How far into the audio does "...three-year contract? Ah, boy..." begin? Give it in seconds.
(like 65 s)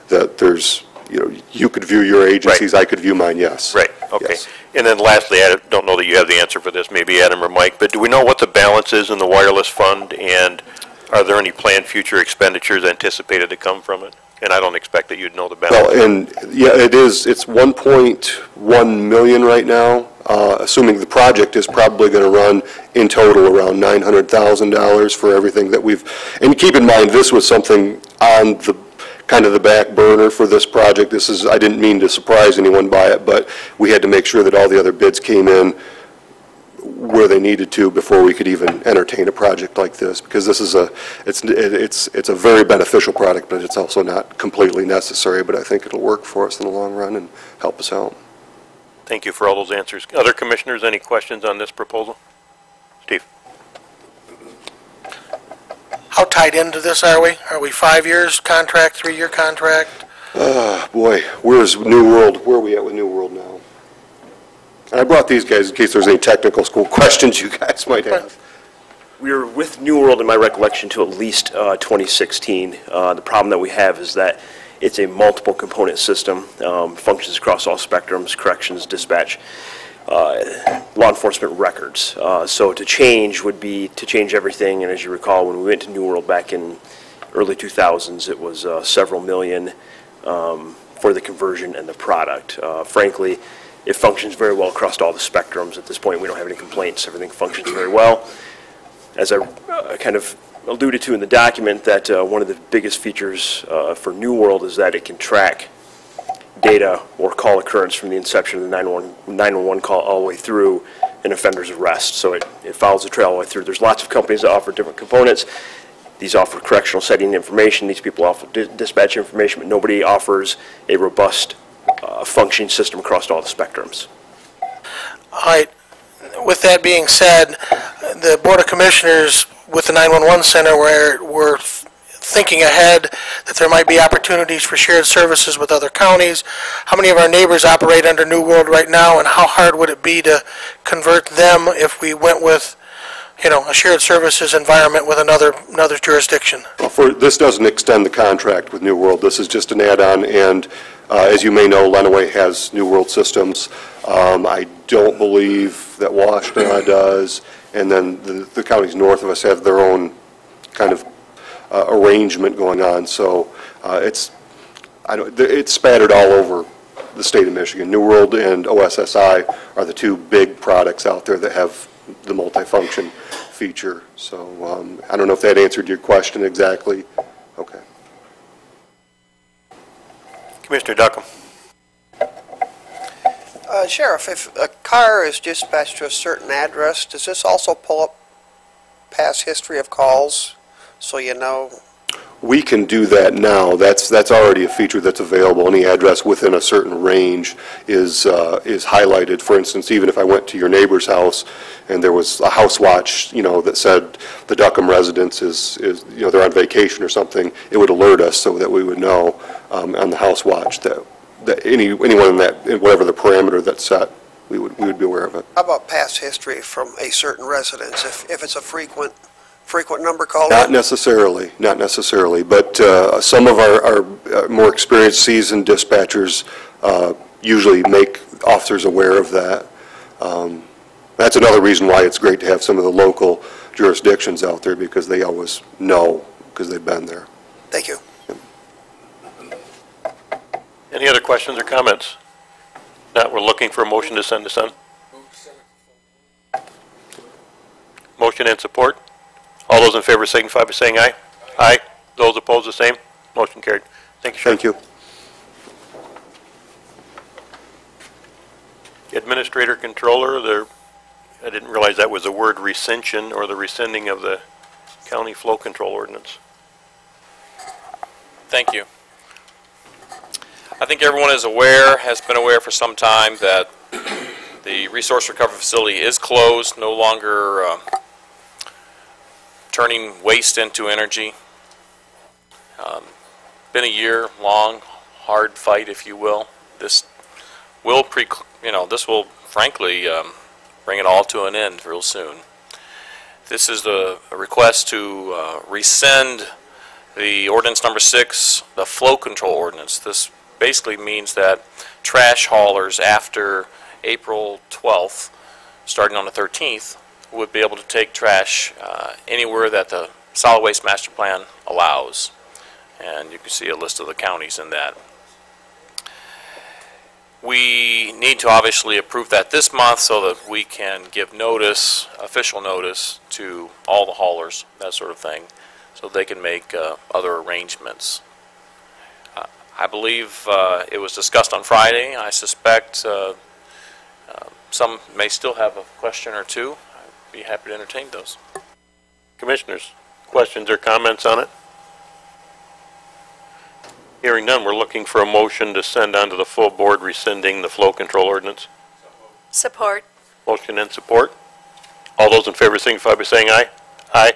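58 s.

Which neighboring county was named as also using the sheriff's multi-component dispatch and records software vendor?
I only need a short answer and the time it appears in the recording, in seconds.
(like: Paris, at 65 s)
Lenawee, at 151 s.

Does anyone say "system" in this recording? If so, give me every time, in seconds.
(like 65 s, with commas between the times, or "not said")
75 s, 122 s, 153 s.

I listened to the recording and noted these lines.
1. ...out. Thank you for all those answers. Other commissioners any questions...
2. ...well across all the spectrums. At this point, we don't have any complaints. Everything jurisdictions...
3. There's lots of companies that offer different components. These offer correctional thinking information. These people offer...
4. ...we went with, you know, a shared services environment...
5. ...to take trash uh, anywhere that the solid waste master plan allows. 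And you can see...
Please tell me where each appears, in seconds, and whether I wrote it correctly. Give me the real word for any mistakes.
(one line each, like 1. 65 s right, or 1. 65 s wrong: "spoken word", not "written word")
1. 47 s right
2. 94 s wrong: "functions", not "jurisdictions"
3. 113 s wrong: "setting", not "thinking"
4. 141 s right
5. 307 s right.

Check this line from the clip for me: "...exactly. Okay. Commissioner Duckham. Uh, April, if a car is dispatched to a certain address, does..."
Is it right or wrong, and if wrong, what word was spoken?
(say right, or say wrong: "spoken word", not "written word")
wrong: "Sheriff", not "April".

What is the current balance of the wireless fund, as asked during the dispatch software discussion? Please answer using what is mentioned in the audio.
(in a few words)
$1.1 million.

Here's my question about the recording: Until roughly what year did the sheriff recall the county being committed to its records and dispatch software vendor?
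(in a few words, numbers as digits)
2016.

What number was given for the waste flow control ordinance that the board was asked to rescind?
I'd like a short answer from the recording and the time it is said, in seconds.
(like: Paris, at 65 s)
6, at 297 s.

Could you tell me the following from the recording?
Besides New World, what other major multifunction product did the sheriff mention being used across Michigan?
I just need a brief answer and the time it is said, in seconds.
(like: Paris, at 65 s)
OSSI, at 168 s.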